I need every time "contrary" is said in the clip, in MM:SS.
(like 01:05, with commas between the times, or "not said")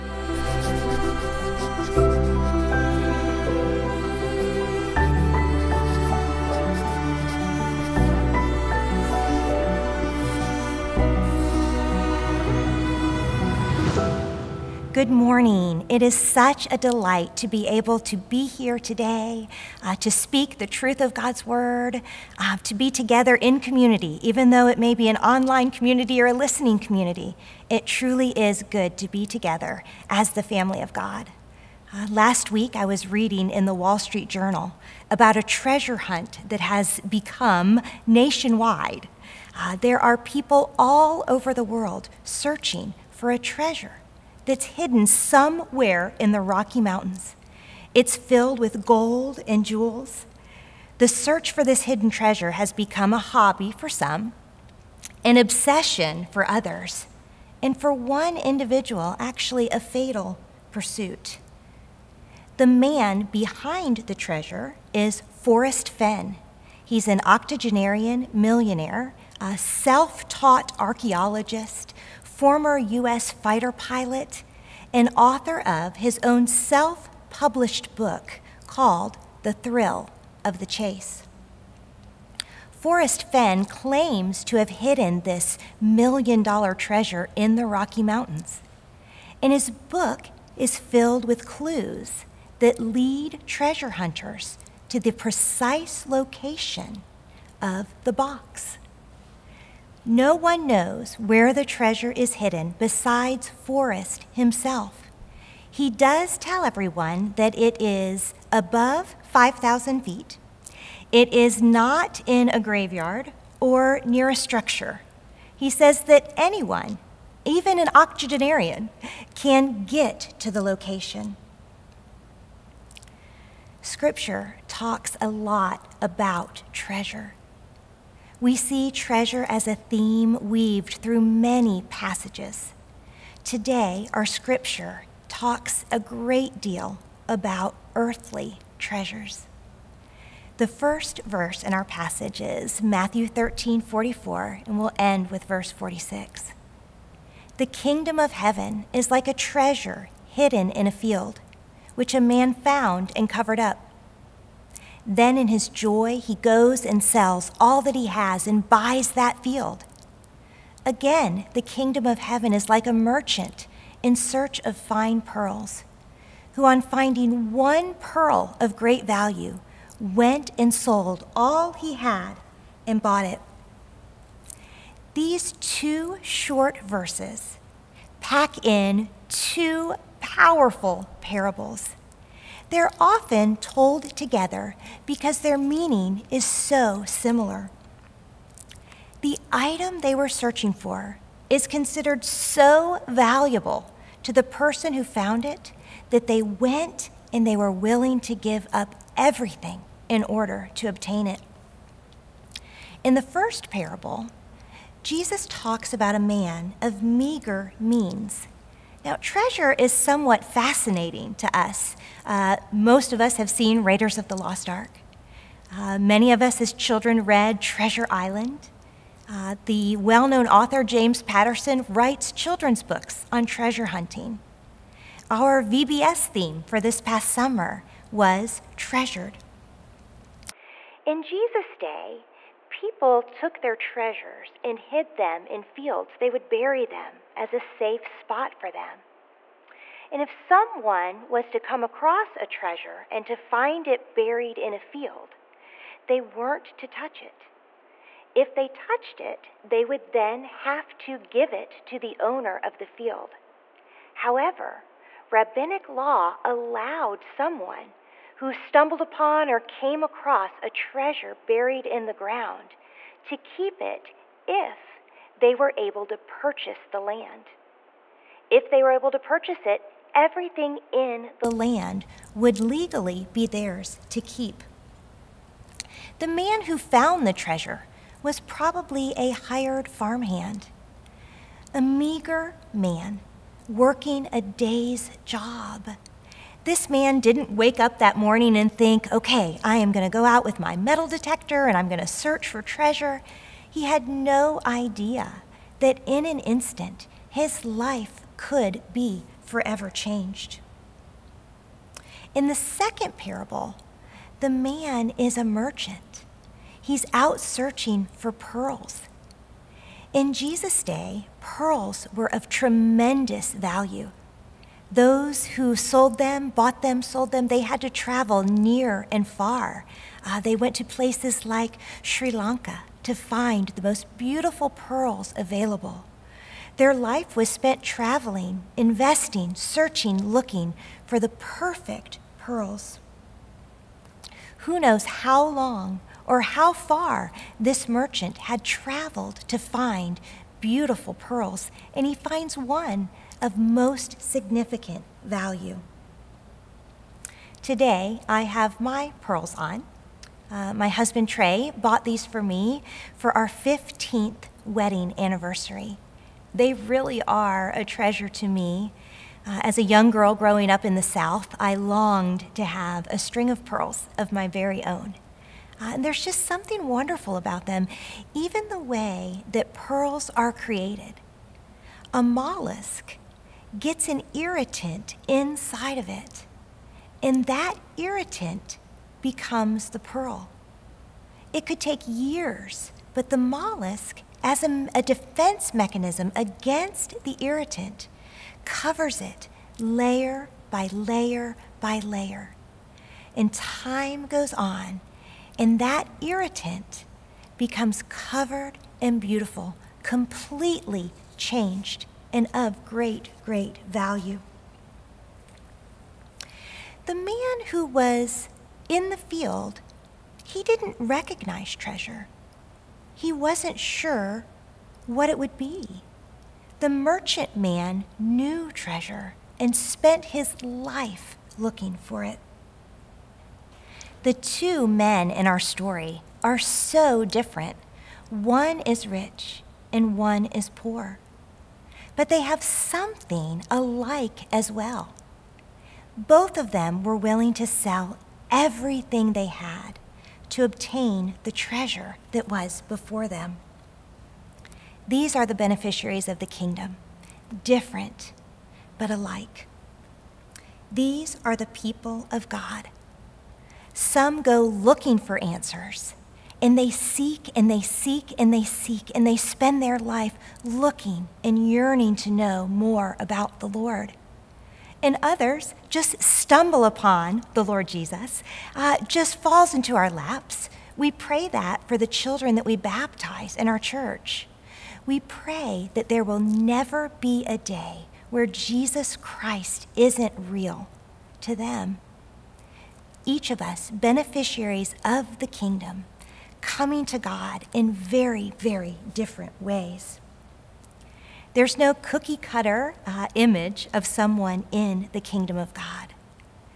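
not said.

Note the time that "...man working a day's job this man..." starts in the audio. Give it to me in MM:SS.
04:42.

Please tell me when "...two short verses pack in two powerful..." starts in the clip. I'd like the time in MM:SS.
02:55.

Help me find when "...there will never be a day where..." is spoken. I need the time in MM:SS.
07:56.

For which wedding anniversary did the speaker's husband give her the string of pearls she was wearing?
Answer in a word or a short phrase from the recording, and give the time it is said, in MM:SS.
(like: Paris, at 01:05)
15th, at 05:53.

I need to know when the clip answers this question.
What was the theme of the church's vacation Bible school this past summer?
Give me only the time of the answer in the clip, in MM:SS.
03:48.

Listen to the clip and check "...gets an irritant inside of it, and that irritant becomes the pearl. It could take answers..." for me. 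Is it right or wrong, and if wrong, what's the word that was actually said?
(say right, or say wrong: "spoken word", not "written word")
wrong: "years", not "answers".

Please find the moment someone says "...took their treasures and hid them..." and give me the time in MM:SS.
03:53.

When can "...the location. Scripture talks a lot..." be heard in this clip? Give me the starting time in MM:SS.
02:00.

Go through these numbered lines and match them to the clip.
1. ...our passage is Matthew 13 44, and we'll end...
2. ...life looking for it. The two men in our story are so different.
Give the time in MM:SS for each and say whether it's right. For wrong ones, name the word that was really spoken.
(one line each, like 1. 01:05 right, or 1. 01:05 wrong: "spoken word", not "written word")
1. 02:21 right
2. 07:00 right.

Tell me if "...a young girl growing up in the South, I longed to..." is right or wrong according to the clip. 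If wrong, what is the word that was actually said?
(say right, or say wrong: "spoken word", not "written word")
right.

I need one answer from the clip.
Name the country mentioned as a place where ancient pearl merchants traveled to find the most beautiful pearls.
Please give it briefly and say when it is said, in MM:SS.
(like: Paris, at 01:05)
Sri Lanka, at 05:22.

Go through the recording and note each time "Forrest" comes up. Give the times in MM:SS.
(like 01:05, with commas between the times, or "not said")
01:05, 01:22, 01:43.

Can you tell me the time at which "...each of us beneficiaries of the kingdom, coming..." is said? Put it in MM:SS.
08:03.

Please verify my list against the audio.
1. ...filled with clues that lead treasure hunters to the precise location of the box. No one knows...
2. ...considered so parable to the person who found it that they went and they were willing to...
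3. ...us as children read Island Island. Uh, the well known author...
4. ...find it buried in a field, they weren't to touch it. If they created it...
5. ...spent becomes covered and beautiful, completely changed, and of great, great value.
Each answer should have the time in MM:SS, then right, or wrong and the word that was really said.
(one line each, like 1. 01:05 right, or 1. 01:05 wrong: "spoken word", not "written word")
1. 01:30 right
2. 03:11 wrong: "valuable", not "parable"
3. 03:36 wrong: "Treasure", not "Island"
4. 04:03 wrong: "touched", not "created"
5. 06:36 wrong: "irritant", not "spent".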